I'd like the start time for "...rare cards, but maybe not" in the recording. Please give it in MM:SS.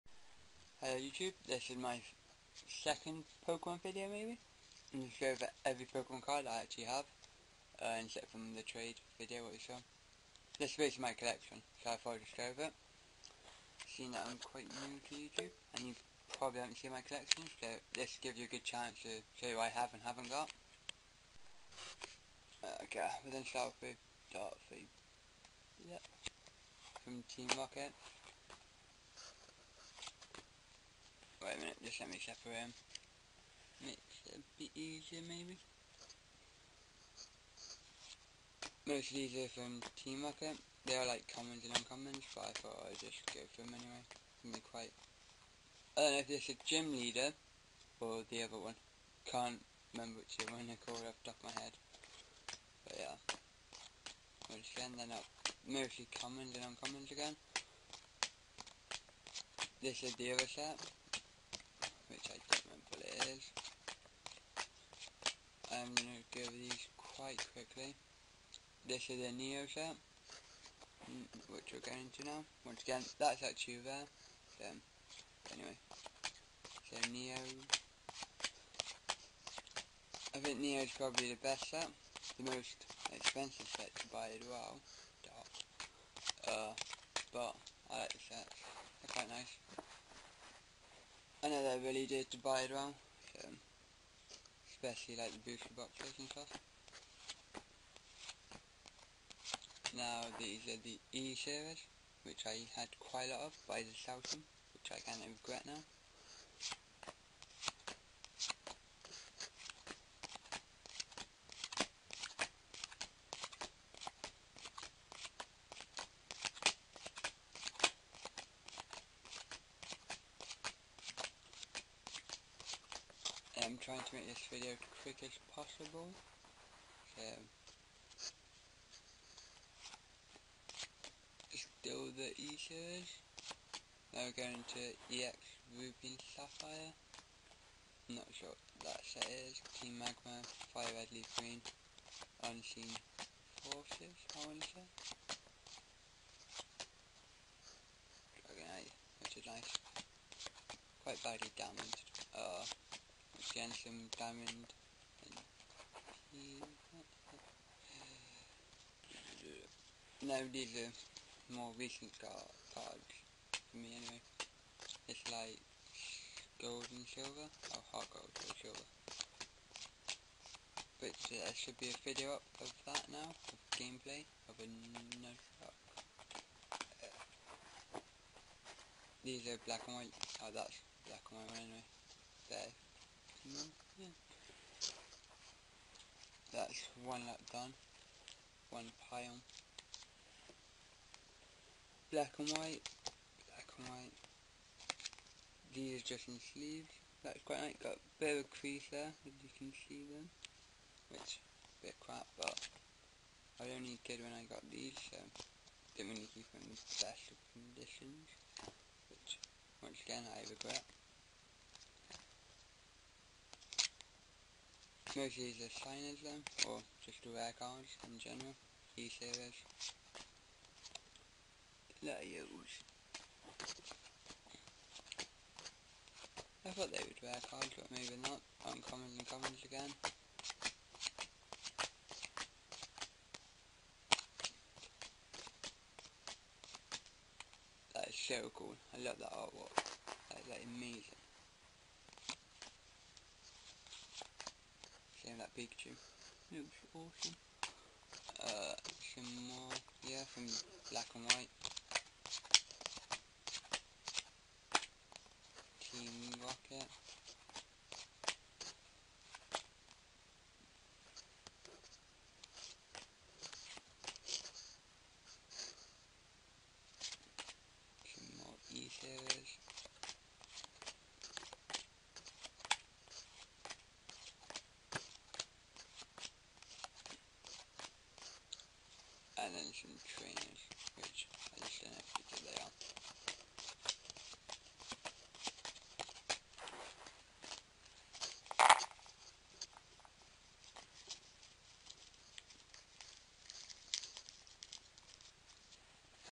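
03:47.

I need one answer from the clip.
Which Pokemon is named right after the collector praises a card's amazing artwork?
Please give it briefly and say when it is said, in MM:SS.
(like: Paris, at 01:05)
Pikachu, at 04:05.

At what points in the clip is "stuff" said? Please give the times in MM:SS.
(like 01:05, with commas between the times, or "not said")
01:36.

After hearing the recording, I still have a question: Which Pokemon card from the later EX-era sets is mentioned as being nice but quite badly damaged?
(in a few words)
Dragonite.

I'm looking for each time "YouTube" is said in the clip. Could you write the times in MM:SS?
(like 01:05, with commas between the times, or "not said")
00:00, 00:15.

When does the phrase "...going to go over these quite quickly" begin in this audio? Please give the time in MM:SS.
01:05.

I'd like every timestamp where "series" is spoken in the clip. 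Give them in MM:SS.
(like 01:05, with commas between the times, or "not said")
01:41, 02:12, 03:38.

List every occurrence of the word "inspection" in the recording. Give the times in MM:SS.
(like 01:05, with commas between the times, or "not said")
not said.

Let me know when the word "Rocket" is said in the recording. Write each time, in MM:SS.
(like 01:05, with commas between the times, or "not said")
00:27, 00:40, 04:16.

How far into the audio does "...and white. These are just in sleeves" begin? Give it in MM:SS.
03:13.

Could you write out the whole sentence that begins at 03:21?
Which, a bit crap, but I only did when I got these, so didn't really keep them in special conditions.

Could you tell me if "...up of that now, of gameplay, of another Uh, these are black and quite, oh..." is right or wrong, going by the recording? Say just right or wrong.
wrong.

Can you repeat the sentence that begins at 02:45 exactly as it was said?
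It's like gold and silver, or oh, HeartGold or silver.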